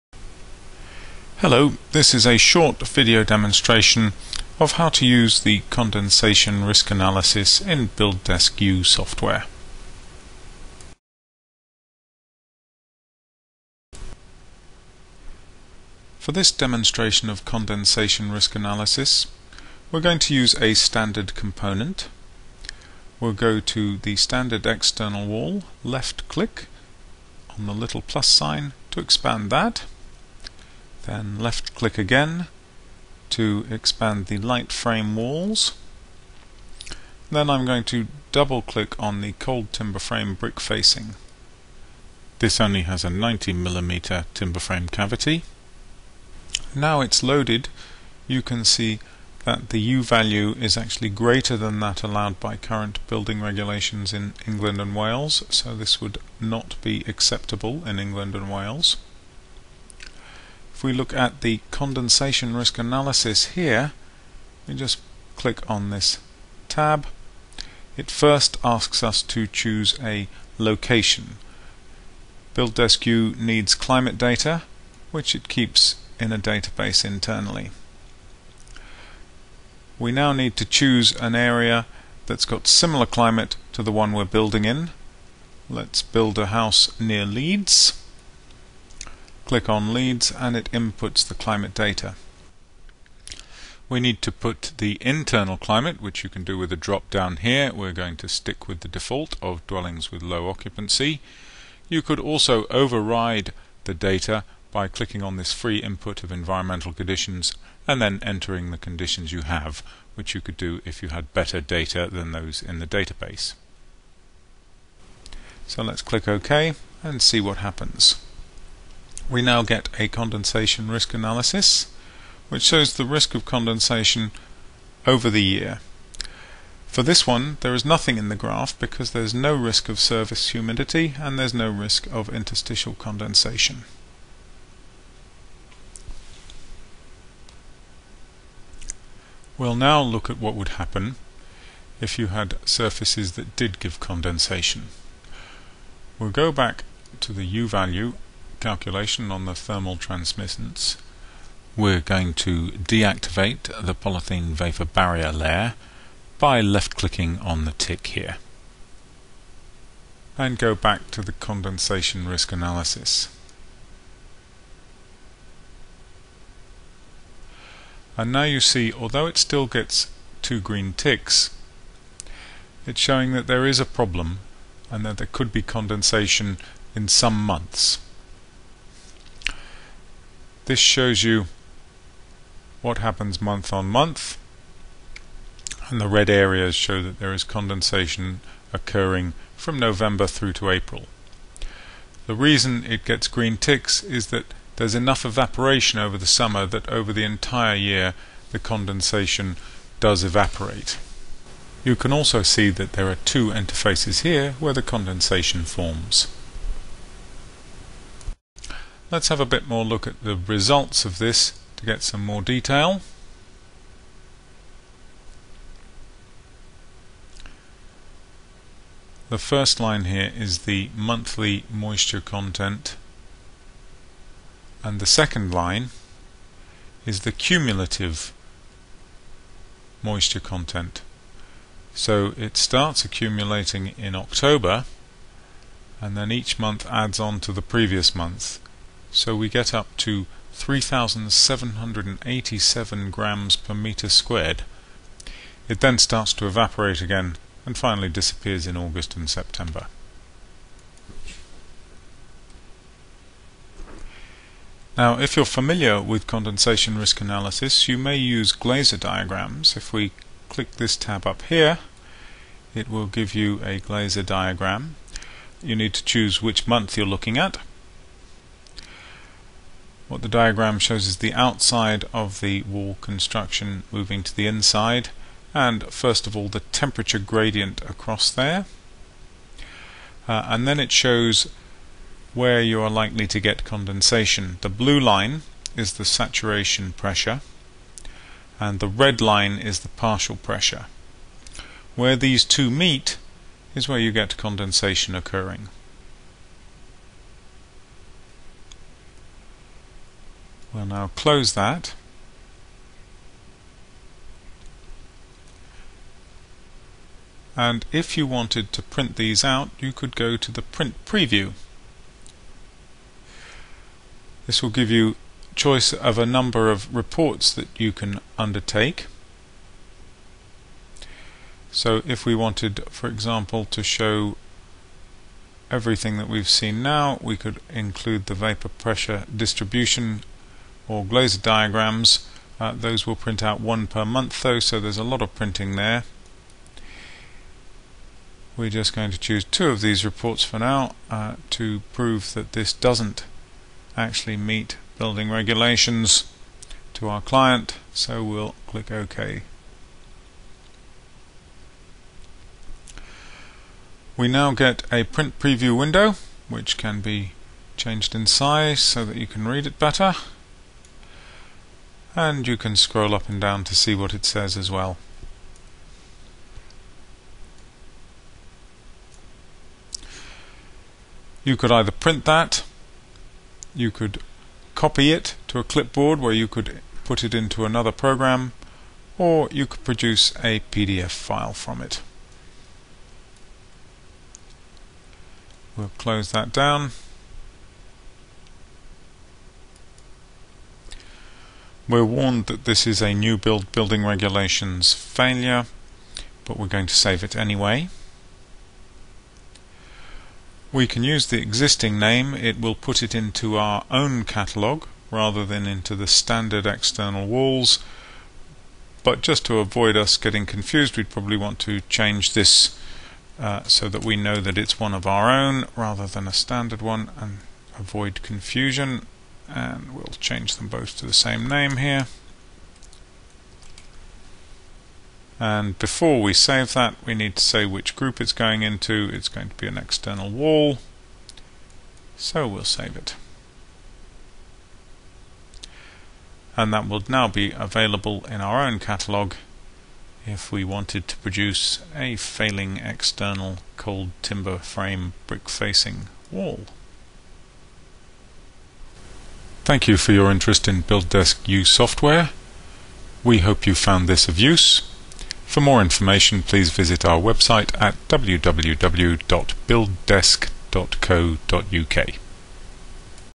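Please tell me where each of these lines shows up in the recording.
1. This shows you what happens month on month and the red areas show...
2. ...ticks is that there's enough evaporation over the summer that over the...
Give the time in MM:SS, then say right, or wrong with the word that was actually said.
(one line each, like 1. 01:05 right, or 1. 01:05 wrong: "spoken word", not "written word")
1. 03:00 right
2. 03:13 right.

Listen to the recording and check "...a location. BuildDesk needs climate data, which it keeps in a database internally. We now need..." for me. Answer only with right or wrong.
right.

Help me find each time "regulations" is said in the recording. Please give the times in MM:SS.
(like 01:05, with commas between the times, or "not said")
00:53, 05:45, 06:34.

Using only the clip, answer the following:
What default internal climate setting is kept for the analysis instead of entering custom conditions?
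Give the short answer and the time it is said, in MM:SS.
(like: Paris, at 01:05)
dwellings with low occupancy, at 01:39.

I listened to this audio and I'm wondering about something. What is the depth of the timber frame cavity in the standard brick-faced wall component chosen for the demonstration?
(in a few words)
90mm.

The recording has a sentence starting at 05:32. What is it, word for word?
Uh, those will print out one per month though, so there's a lot of printing there.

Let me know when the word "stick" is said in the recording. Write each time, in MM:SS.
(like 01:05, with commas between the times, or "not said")
01:38.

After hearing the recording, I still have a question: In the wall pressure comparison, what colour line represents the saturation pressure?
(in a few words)
blue.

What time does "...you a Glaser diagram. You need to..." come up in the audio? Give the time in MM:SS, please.
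04:23.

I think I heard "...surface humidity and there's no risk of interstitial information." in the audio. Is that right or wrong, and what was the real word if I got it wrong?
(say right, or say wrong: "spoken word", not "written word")
wrong: "condensation", not "information".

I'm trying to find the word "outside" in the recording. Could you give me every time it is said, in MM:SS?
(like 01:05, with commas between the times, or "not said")
04:31.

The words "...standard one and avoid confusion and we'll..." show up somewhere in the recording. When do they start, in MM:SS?
06:56.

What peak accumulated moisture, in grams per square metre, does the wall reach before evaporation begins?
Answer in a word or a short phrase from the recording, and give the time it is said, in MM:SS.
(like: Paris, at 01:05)
3,787, at 04:00.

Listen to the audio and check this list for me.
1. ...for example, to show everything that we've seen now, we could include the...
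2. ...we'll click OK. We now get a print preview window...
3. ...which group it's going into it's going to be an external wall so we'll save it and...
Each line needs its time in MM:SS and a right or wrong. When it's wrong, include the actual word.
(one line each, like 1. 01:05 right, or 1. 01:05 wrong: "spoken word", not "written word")
1. 05:22 right
2. 05:48 right
3. 07:07 right.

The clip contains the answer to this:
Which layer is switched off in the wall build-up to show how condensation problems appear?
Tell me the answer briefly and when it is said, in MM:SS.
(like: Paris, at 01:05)
polythene vapor barrier, at 02:33.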